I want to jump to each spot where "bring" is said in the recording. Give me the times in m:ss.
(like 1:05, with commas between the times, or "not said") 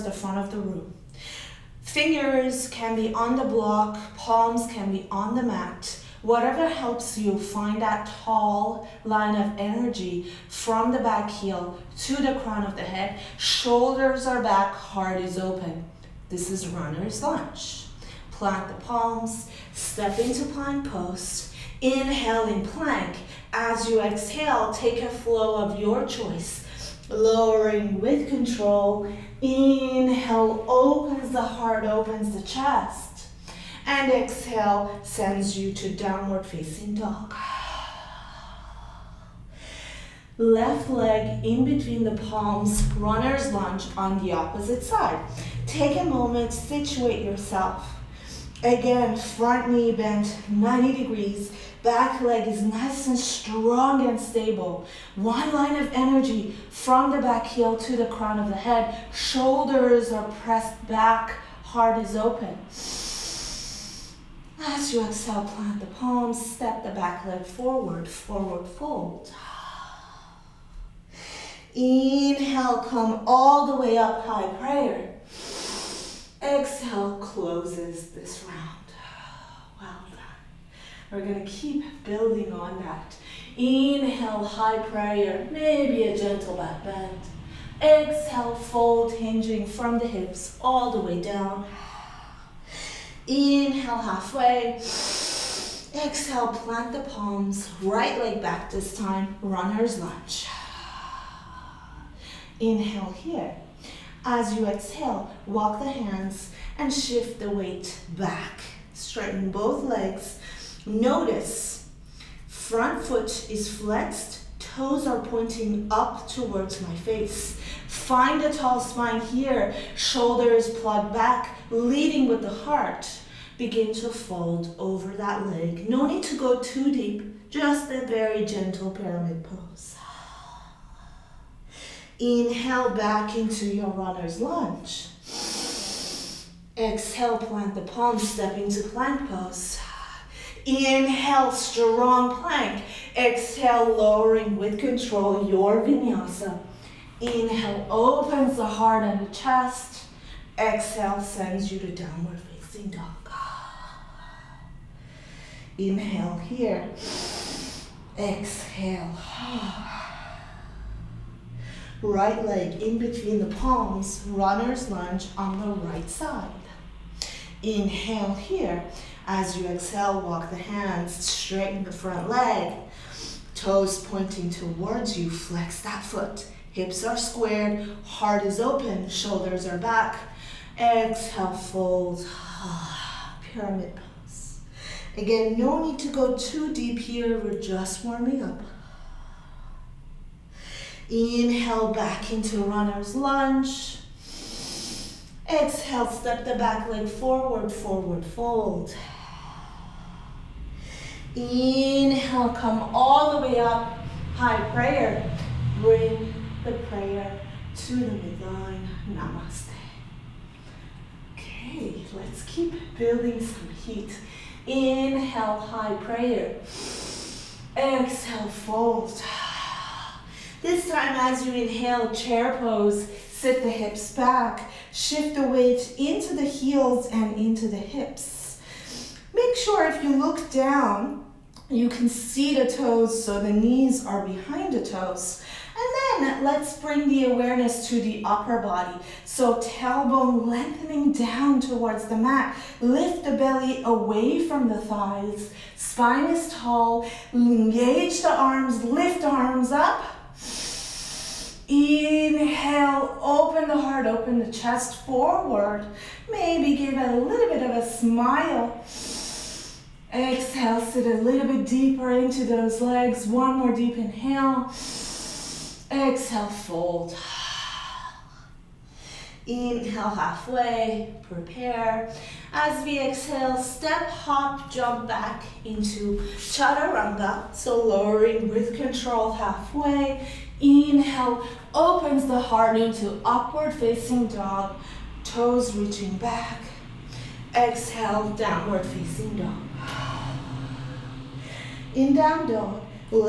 3:25, 3:56.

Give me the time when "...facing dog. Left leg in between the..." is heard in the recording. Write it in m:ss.
0:36.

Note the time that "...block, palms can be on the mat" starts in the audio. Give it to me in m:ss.
0:03.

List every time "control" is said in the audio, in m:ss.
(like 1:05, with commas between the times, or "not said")
0:28, 2:24, 4:38.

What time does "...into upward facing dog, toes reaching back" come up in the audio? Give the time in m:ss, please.
4:42.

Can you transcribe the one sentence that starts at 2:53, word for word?
Toes pointing towards you, flex that foot.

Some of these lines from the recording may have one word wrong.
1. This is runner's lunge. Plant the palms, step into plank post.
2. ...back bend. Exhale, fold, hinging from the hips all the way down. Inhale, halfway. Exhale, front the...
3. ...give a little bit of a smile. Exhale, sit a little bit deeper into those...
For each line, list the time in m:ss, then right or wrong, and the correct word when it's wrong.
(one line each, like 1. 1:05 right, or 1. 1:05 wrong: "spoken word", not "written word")
1. 0:16 right
2. 1:26 wrong: "plant", not "front"
3. 4:16 right.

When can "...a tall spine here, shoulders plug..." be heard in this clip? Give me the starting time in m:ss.
1:58.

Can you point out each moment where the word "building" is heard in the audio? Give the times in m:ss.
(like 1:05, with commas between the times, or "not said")
1:22, 3:32.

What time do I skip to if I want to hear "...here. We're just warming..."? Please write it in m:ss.
3:06.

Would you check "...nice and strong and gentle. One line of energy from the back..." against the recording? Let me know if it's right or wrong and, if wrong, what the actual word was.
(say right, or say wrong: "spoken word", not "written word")
wrong: "stable", not "gentle".